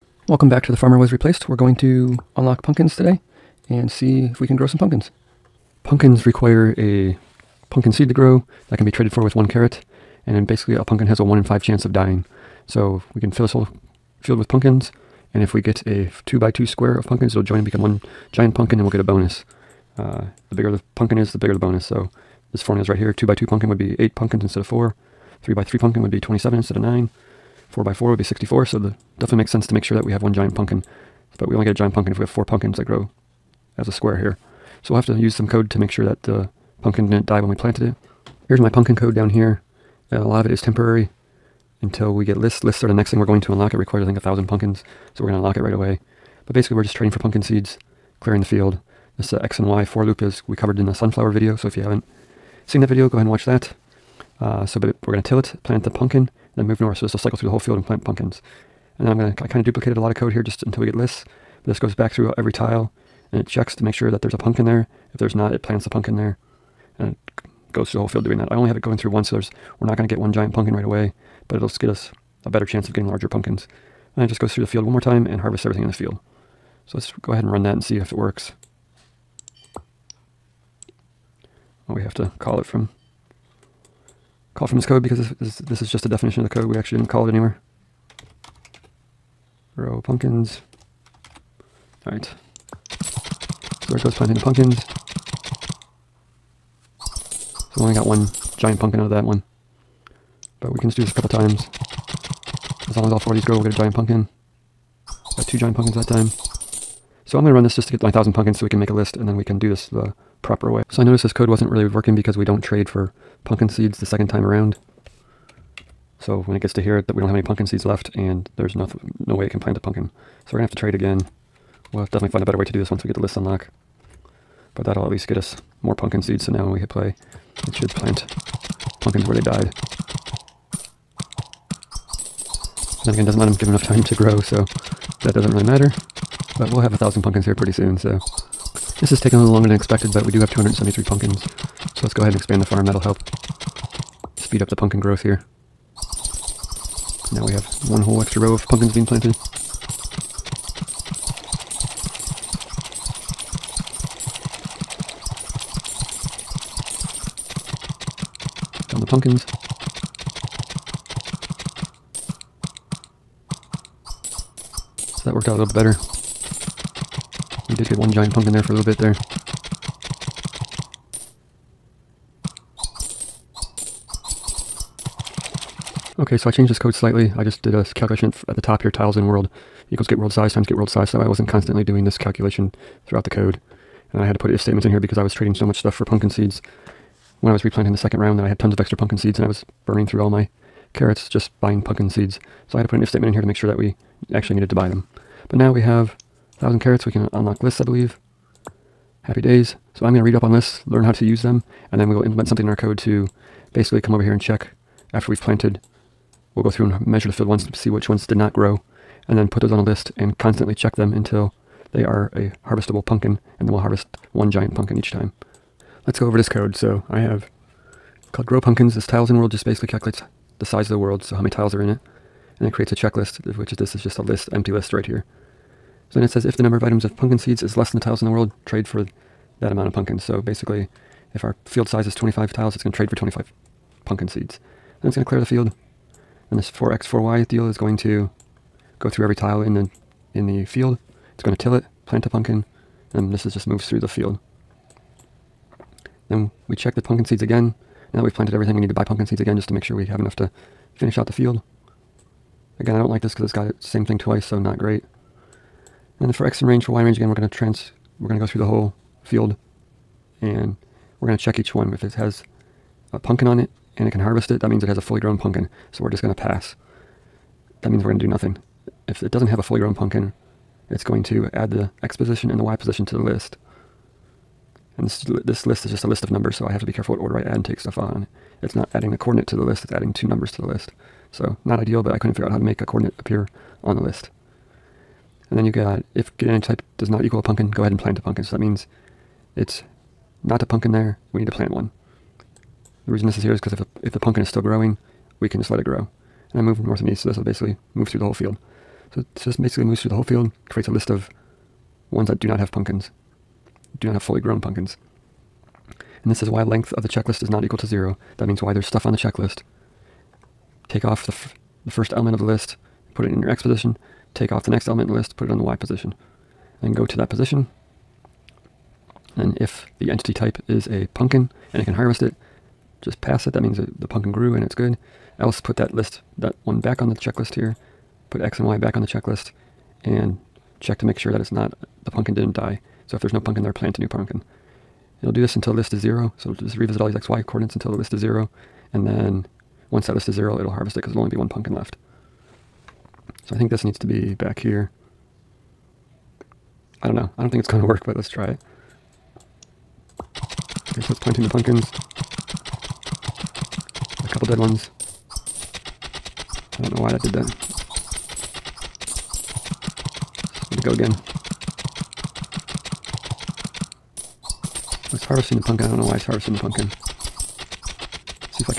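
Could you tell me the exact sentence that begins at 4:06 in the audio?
Then we check the pumpkin seeds again.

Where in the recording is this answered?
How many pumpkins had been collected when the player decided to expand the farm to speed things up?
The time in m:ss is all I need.
2:20.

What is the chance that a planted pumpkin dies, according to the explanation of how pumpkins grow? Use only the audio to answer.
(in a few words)
1 in 5.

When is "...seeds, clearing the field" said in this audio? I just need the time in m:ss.
0:47.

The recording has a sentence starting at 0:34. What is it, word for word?
So we'll have to use some code to make sure that the pumpkin didn't die when we planted it.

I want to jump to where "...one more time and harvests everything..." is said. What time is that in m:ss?
1:14.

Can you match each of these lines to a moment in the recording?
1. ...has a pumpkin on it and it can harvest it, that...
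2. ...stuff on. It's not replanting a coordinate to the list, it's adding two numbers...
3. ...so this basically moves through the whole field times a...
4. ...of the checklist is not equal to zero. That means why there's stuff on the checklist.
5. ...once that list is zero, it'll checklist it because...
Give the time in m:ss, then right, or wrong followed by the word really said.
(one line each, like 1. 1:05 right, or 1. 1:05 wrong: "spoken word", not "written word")
1. 4:22 right
2. 4:37 wrong: "adding", not "replanting"
3. 4:59 wrong: "creates", not "times"
4. 5:06 right
5. 5:39 wrong: "harvest", not "checklist".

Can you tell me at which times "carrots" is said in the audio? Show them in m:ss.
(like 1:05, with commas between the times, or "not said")
0:09, 3:10, 3:16.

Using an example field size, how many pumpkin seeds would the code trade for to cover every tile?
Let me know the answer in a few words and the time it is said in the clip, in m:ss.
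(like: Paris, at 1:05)
25, at 3:53.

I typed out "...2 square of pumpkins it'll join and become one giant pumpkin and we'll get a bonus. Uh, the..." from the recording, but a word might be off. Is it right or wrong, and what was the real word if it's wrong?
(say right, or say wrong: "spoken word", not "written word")
right.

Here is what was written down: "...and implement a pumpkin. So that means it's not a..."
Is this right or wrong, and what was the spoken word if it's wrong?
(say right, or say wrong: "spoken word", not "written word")
wrong: "plant", not "implement".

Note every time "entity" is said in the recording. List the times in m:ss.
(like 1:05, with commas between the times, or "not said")
4:46, 5:20.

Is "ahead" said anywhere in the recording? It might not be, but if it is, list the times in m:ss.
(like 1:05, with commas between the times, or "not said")
0:53, 1:17, 2:22, 4:47.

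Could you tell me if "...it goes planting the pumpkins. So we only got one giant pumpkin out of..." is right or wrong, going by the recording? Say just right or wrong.
right.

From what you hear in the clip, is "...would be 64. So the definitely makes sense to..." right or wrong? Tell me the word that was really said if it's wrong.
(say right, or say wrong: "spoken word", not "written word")
right.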